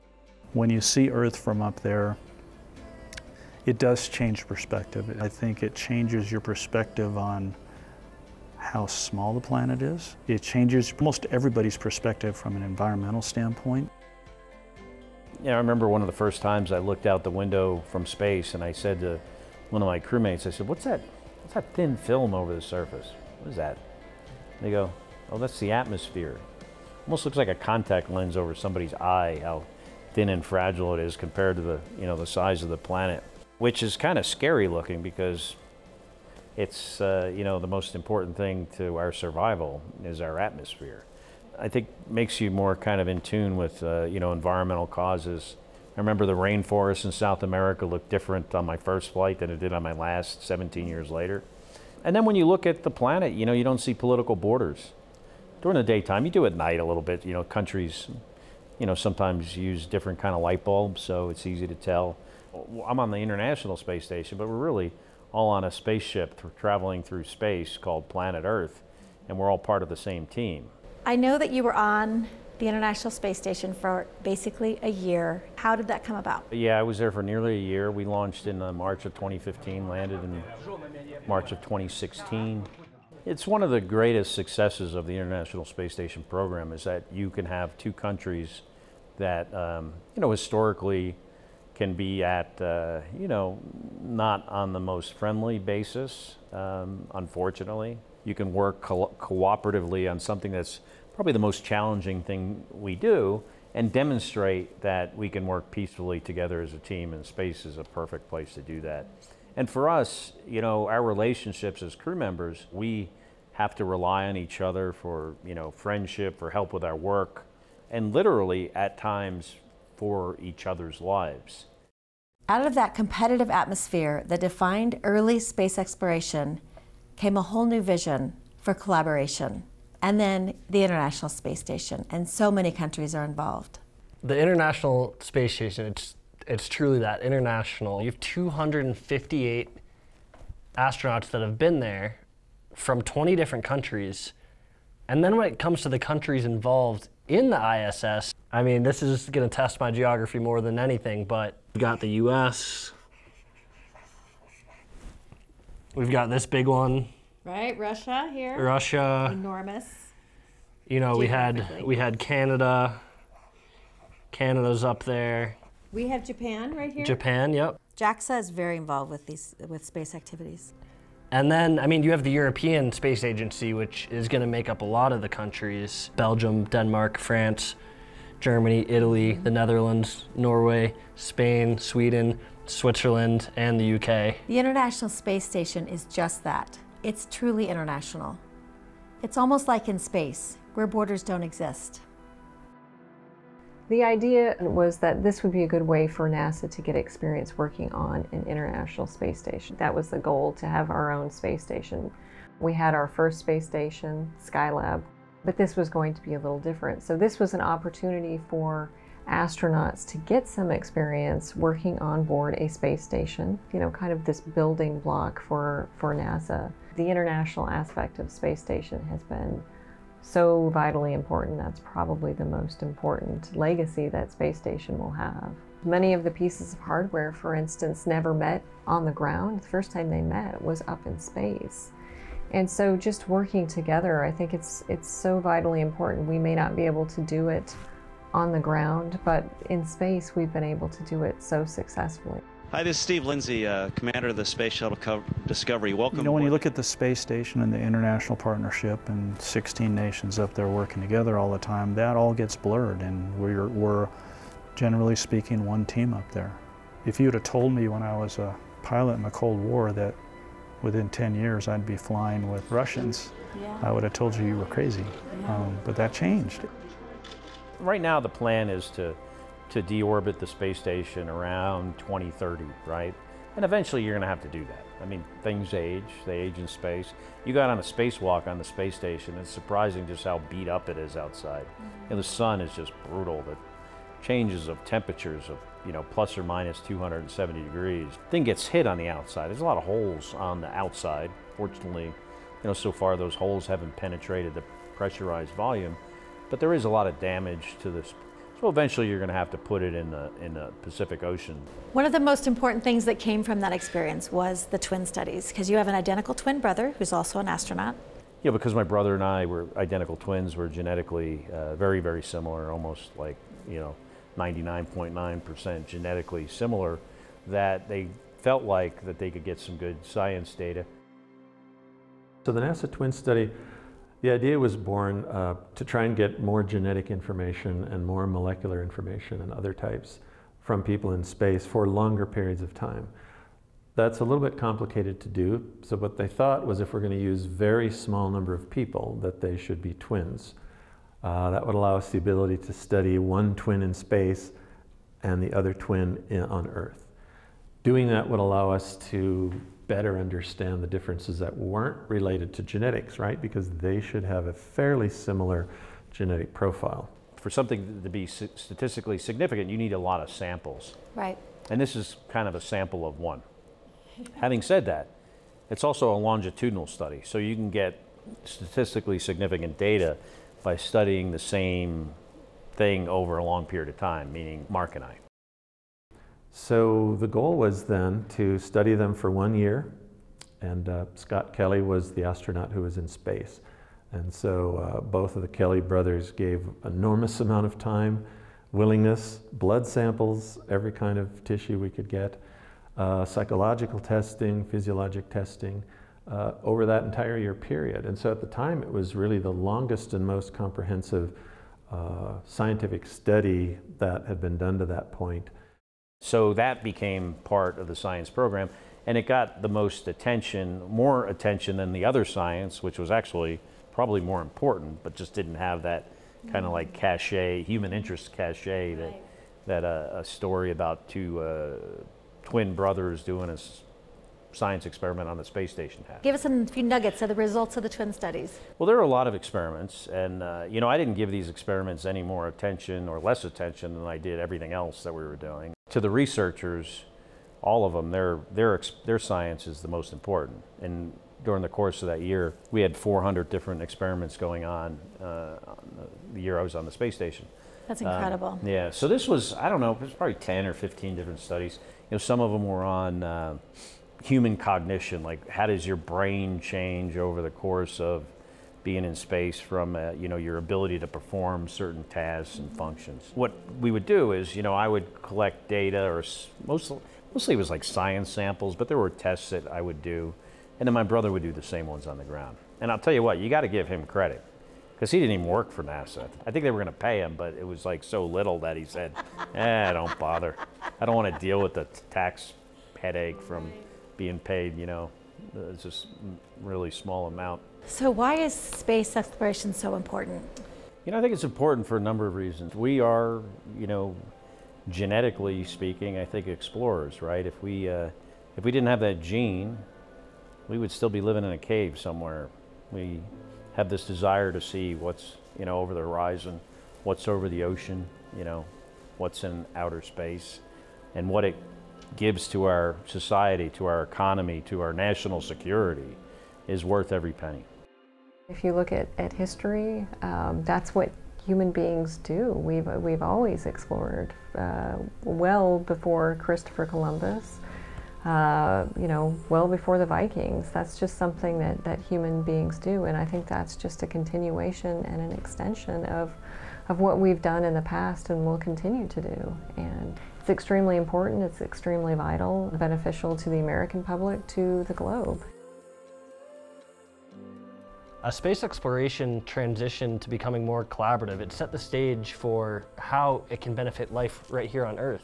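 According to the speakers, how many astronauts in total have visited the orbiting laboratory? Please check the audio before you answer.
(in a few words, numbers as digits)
258.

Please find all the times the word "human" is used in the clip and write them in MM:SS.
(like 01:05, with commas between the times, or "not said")
06:57, 07:34, 08:41, 08:52.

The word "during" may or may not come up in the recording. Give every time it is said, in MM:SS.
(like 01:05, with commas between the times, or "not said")
00:55, 07:21.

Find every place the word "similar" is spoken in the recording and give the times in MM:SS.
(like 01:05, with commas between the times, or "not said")
05:12, 05:16, 05:55.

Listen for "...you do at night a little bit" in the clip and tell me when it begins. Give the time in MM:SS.
00:56.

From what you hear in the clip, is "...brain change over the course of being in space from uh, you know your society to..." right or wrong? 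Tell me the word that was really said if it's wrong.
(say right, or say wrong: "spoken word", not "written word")
wrong: "ability", not "society".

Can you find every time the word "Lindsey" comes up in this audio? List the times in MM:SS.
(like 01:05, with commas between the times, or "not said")
04:03.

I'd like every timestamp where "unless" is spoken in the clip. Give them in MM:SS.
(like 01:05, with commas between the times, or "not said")
not said.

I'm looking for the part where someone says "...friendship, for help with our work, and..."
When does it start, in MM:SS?
01:55.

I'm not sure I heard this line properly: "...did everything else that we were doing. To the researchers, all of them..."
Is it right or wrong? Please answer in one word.
right.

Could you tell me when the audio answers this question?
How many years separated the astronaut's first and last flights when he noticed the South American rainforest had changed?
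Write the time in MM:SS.
00:50.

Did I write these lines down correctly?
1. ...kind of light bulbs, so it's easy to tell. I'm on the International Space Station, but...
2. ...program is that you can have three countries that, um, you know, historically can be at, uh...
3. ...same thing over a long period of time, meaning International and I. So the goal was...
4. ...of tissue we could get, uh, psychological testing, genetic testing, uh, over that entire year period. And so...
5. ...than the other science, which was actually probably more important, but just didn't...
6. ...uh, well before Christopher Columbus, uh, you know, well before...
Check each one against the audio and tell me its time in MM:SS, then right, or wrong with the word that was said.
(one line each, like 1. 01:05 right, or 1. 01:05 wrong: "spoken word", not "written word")
1. 01:00 right
2. 01:26 wrong: "two", not "three"
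3. 06:11 wrong: "Mark", not "International"
4. 06:31 wrong: "physiologic", not "genetic"
5. 06:51 right
6. 08:44 right.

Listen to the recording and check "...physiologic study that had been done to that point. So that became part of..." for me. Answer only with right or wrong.
wrong.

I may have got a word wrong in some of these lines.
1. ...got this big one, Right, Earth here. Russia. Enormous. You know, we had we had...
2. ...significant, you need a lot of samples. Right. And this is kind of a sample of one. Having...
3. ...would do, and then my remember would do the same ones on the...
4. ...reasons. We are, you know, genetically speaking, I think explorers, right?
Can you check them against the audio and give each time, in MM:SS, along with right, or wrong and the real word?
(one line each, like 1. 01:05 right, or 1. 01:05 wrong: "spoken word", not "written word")
1. 02:36 wrong: "Russia", not "Earth"
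2. 05:59 right
3. 07:49 wrong: "brother", not "remember"
4. 08:12 right.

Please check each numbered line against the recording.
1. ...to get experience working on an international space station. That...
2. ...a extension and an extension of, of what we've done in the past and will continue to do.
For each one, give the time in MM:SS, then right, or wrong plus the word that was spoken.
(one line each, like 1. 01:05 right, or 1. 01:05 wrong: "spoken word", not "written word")
1. 03:16 right
2. 08:54 wrong: "continuation", not "extension".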